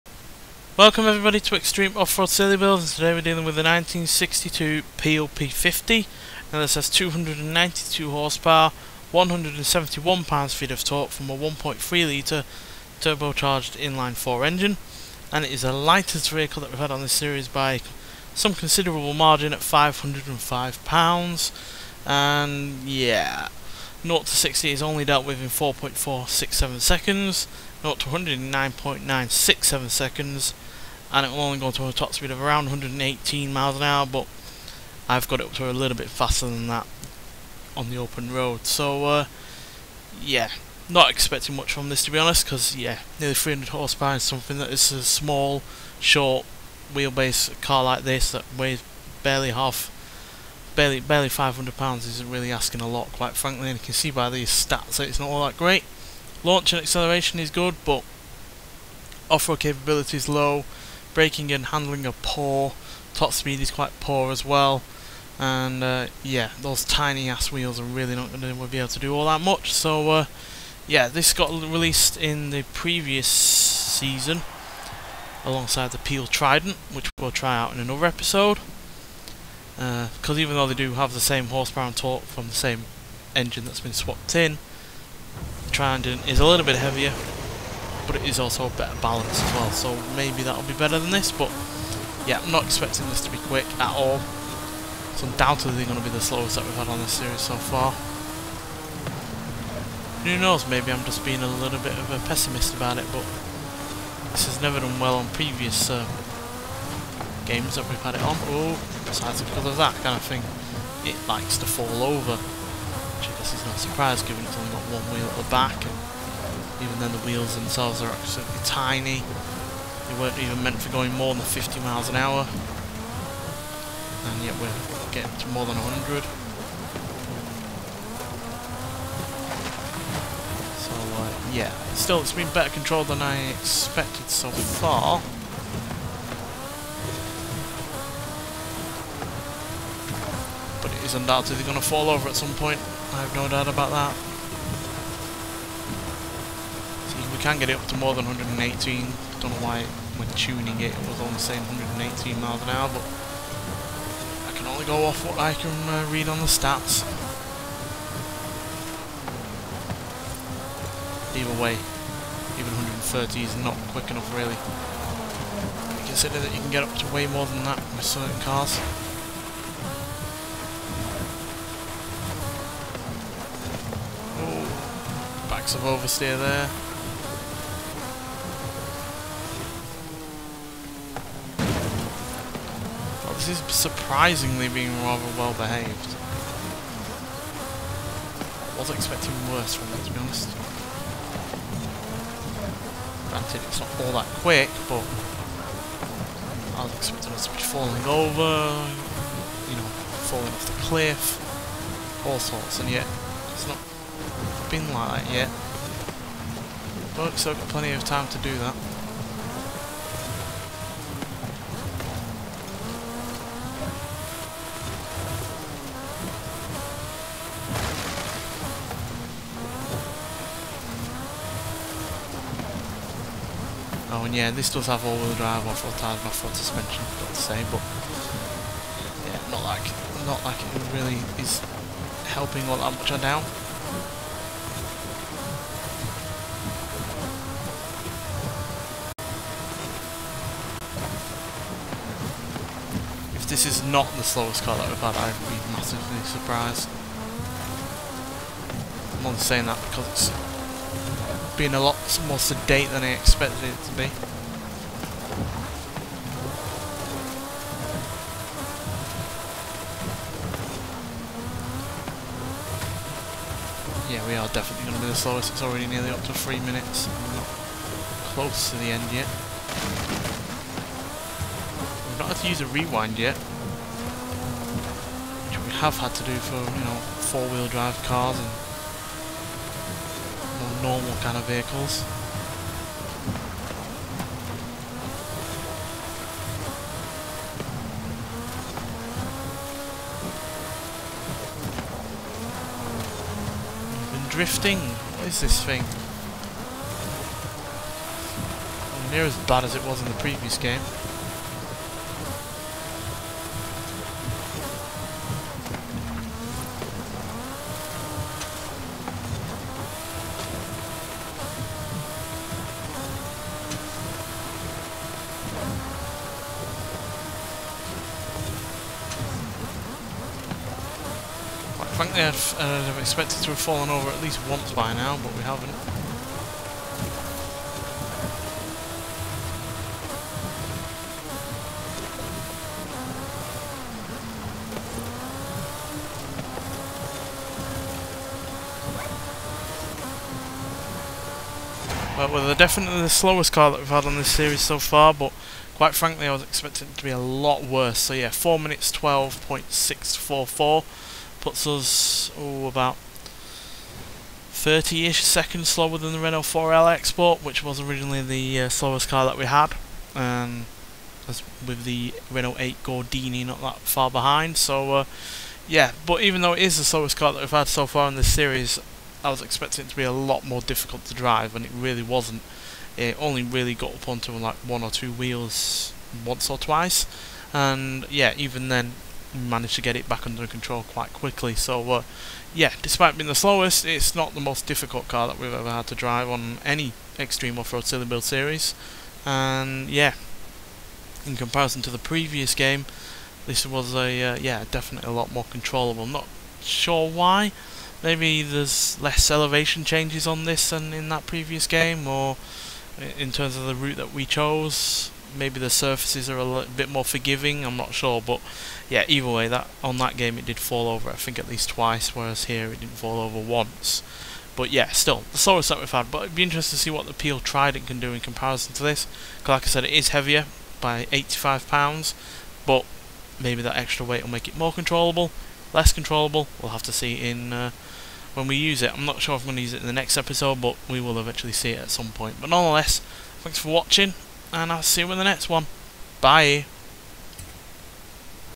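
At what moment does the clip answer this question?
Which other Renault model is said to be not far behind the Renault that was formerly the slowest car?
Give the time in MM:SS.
06:02.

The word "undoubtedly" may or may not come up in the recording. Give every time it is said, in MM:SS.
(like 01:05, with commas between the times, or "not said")
01:35, 02:21.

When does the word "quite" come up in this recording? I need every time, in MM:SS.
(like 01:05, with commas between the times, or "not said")
00:53, 01:03, 05:45, 06:20.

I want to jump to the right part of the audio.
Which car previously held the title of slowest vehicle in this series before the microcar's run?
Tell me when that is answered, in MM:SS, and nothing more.
05:56.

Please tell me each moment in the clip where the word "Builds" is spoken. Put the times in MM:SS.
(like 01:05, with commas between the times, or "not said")
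00:02, 06:28.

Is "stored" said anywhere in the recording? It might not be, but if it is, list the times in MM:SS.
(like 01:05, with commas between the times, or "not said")
not said.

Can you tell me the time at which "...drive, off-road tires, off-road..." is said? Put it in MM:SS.
03:45.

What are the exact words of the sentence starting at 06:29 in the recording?
And yeah, in comparison to the previous game, this was a uh, yeah definitely a lot more controllable.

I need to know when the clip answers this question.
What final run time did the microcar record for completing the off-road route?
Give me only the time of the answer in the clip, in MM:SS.
05:48.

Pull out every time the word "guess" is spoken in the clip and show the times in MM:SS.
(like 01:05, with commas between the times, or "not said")
01:53.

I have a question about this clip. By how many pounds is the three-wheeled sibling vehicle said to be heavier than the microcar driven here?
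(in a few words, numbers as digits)
85.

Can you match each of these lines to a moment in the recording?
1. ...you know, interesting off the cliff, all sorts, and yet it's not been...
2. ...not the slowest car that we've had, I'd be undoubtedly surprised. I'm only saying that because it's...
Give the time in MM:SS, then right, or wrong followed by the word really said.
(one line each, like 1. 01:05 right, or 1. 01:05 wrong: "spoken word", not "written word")
1. 03:19 wrong: "falling", not "interesting"
2. 04:03 wrong: "massively", not "undoubtedly".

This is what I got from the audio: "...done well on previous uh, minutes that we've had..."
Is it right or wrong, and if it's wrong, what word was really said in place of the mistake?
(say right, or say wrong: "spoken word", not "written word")
wrong: "games", not "minutes".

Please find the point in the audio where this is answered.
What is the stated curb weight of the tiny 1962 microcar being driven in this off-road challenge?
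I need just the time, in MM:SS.
00:19.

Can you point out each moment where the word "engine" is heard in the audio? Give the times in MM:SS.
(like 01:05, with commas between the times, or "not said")
00:14, 01:23.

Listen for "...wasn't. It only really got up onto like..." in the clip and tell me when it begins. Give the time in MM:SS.
06:12.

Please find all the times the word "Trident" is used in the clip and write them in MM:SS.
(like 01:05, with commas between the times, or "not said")
01:16, 01:25, 06:57.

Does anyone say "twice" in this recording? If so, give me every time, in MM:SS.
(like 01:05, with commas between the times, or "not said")
06:16, 06:51.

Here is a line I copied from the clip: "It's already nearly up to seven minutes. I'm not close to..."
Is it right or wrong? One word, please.
wrong.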